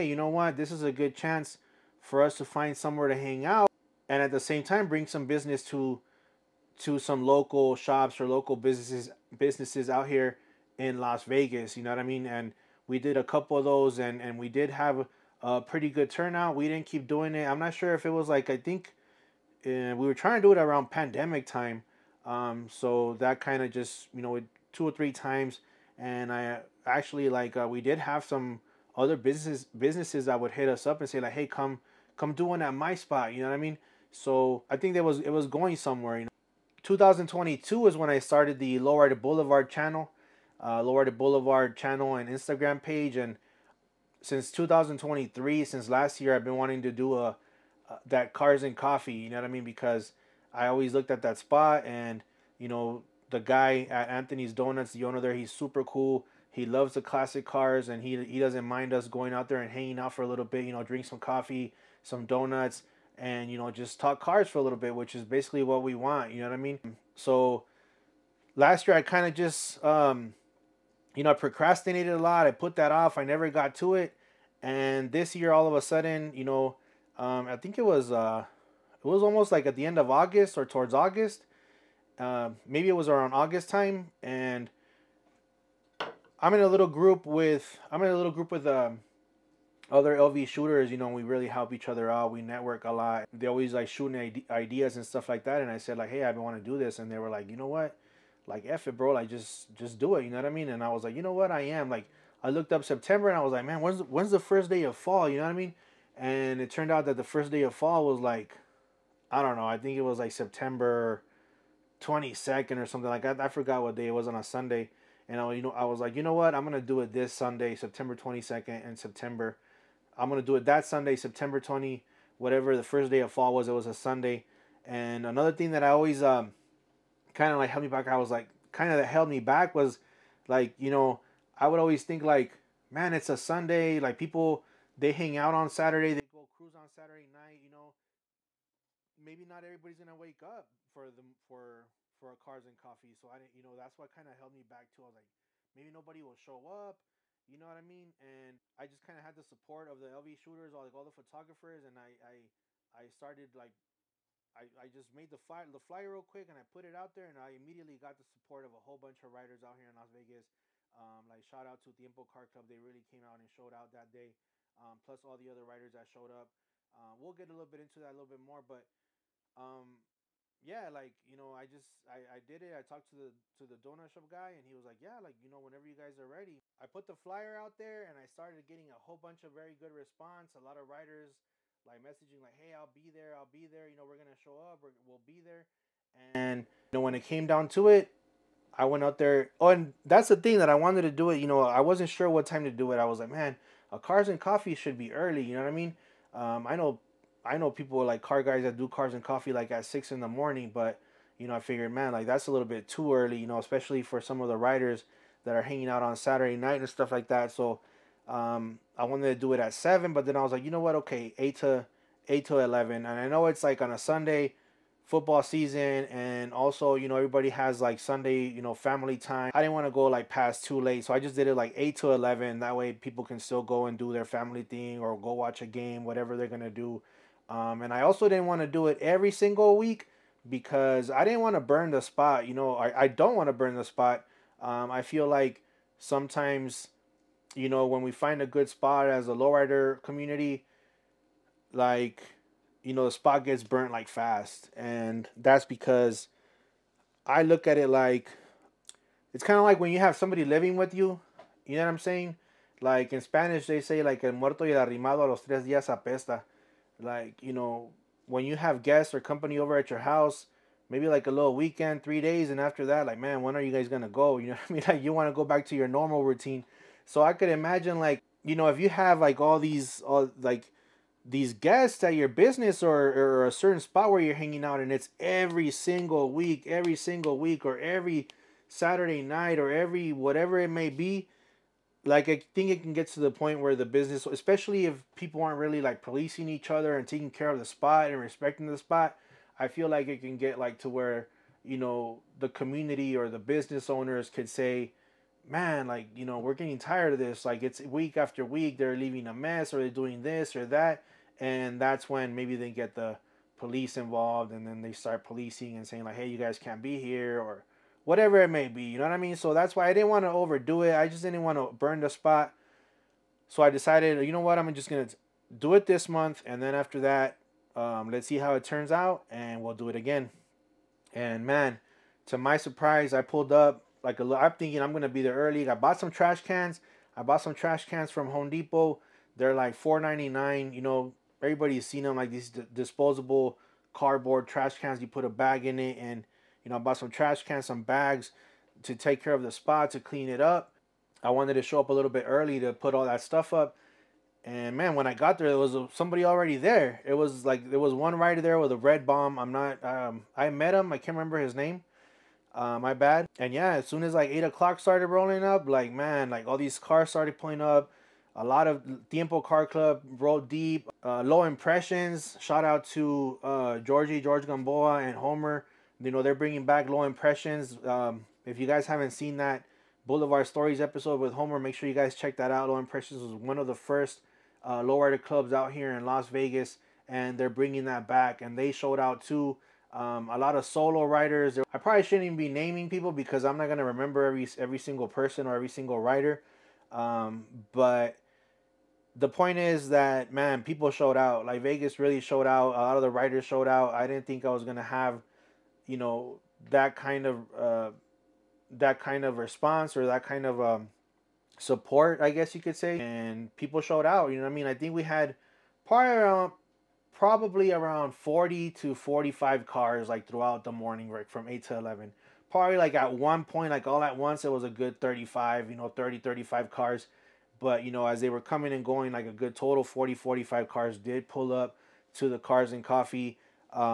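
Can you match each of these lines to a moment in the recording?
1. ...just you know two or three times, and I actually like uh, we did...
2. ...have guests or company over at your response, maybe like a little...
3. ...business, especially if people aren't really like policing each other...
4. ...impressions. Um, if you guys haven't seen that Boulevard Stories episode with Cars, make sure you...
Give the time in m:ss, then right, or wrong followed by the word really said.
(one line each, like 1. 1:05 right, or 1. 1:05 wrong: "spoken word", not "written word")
1. 0:23 right
2. 4:18 wrong: "house", not "response"
3. 4:43 right
4. 6:07 wrong: "Homer", not "Cars".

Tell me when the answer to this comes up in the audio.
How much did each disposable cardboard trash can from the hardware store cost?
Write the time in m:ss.
5:29.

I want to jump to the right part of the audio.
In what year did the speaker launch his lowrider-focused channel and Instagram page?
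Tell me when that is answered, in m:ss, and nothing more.
0:36.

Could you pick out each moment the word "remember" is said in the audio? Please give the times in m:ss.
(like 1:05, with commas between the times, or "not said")
5:51, 6:23.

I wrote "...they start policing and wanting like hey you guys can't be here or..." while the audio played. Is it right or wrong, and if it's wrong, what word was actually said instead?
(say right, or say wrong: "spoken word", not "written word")
wrong: "saying", not "wanting".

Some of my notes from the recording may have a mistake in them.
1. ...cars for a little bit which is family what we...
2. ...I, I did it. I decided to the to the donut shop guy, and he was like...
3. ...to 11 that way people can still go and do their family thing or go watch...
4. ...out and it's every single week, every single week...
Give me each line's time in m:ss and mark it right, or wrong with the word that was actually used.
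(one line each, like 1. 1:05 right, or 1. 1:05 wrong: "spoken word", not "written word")
1. 1:04 wrong: "basically", not "family"
2. 2:52 wrong: "talked", not "decided"
3. 3:41 right
4. 4:34 right.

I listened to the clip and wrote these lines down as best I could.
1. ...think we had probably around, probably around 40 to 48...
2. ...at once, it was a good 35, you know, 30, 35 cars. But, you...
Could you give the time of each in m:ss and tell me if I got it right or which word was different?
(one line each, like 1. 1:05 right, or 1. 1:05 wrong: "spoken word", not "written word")
1. 6:44 wrong: "45", not "48"
2. 6:54 right.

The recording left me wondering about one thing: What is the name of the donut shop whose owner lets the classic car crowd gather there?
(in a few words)
Anthony's Donuts.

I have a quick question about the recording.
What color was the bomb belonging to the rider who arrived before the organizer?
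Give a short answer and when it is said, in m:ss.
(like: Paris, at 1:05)
Red, at 5:48.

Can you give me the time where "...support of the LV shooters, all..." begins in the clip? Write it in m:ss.
2:29.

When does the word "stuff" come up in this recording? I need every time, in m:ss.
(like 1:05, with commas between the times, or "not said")
1:35, 3:26, 5:43.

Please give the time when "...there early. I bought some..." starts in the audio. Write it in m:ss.
5:25.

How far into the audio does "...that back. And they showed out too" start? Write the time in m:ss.
6:17.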